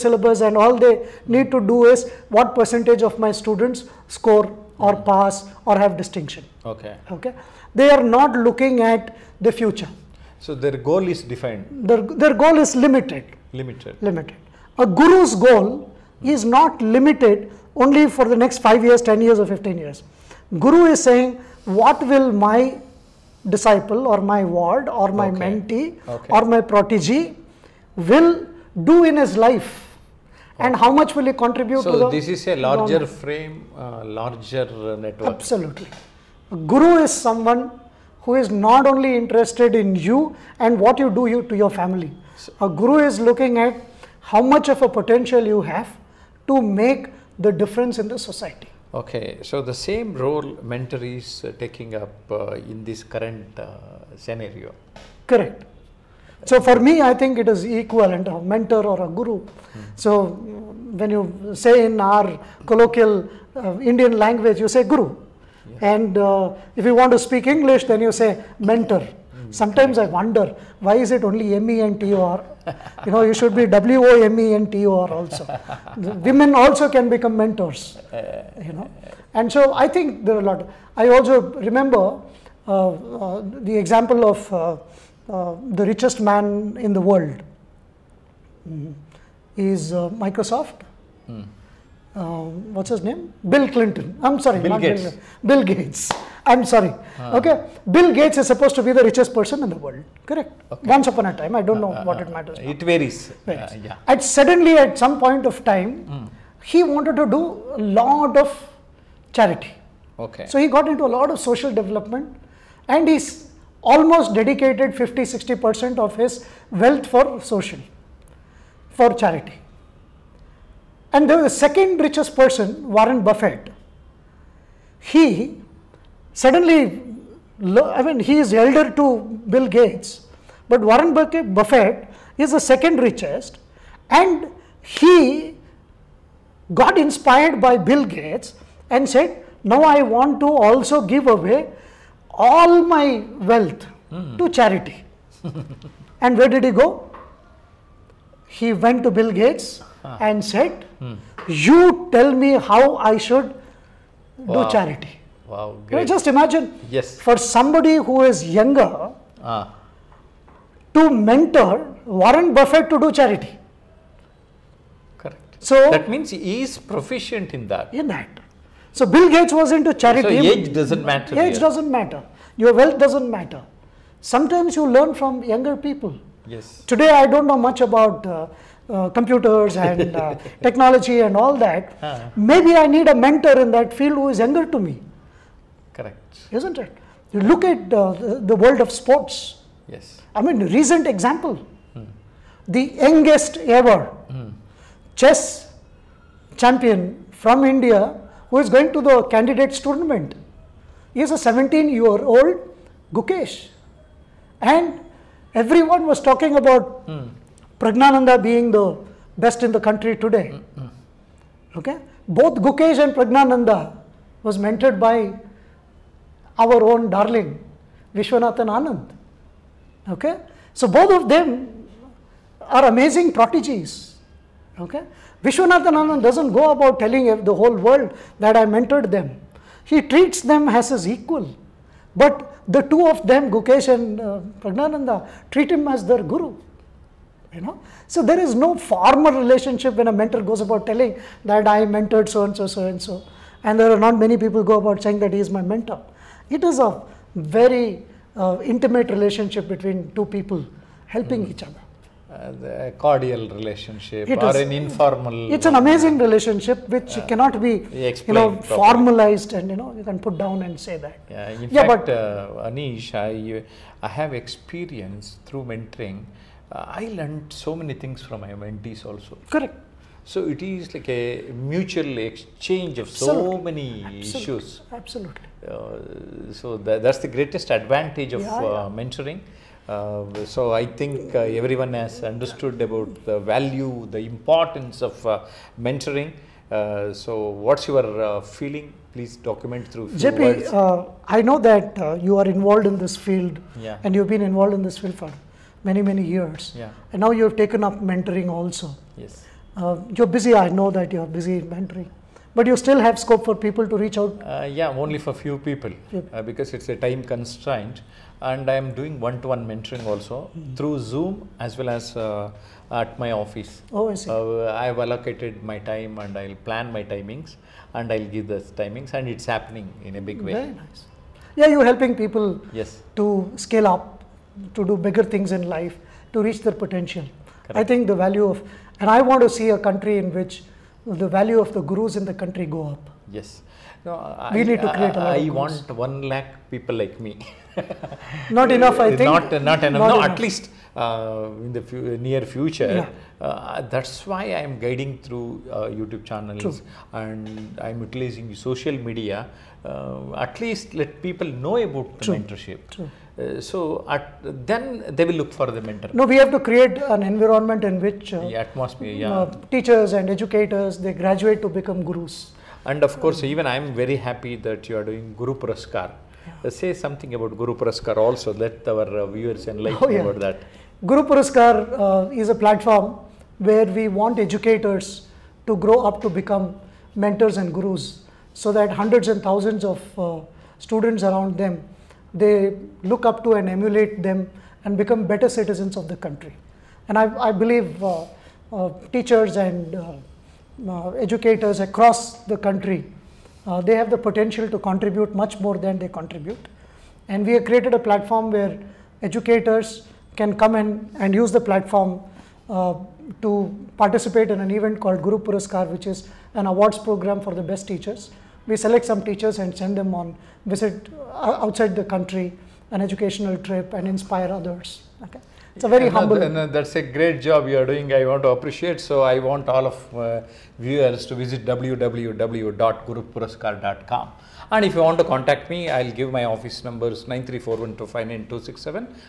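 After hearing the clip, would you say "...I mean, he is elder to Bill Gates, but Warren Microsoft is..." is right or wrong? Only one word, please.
wrong.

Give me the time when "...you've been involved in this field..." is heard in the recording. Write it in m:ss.
4:54.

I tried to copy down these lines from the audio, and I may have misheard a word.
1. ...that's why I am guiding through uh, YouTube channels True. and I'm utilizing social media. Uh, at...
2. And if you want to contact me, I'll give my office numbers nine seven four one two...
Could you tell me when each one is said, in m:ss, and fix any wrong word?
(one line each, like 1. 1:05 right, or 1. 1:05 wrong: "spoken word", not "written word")
1. 5:43 right
2. 7:04 wrong: "three", not "seven".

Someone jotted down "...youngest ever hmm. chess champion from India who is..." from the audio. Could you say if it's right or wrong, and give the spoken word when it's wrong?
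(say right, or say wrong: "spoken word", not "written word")
right.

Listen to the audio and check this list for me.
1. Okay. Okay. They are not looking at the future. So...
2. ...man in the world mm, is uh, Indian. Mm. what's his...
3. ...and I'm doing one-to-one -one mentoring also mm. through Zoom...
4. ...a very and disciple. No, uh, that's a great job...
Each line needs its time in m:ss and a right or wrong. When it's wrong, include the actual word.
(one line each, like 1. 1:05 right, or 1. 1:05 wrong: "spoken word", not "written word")
1. 0:06 right
2. 1:26 wrong: "Microsoft", not "Indian"
3. 5:08 right
4. 6:55 wrong: "humble", not "disciple".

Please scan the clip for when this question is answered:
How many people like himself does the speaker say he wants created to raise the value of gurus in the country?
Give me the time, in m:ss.
5:36.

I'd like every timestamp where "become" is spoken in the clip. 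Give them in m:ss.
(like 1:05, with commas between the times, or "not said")
1:17, 6:01, 6:16, 6:24.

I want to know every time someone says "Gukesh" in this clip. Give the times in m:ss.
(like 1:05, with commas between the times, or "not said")
3:23, 3:32, 3:53.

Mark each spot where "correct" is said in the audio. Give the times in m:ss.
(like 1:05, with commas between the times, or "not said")
0:55, 1:40, 2:45, 3:05, 4:29, 5:27.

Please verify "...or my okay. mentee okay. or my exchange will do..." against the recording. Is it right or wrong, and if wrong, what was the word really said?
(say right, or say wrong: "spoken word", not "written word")
wrong: "protege", not "exchange".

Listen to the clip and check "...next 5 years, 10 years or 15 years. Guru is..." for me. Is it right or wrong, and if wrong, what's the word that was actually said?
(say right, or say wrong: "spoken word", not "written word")
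right.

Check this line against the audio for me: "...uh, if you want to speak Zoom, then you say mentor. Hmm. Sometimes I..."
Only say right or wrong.
wrong.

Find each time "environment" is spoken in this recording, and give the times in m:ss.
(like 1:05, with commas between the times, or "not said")
5:57.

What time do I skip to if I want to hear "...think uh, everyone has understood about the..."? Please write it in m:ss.
4:40.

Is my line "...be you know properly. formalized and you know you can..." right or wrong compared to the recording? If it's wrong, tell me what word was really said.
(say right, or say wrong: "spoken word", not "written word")
right.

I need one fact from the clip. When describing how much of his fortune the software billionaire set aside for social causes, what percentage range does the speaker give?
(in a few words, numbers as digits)
50-60%.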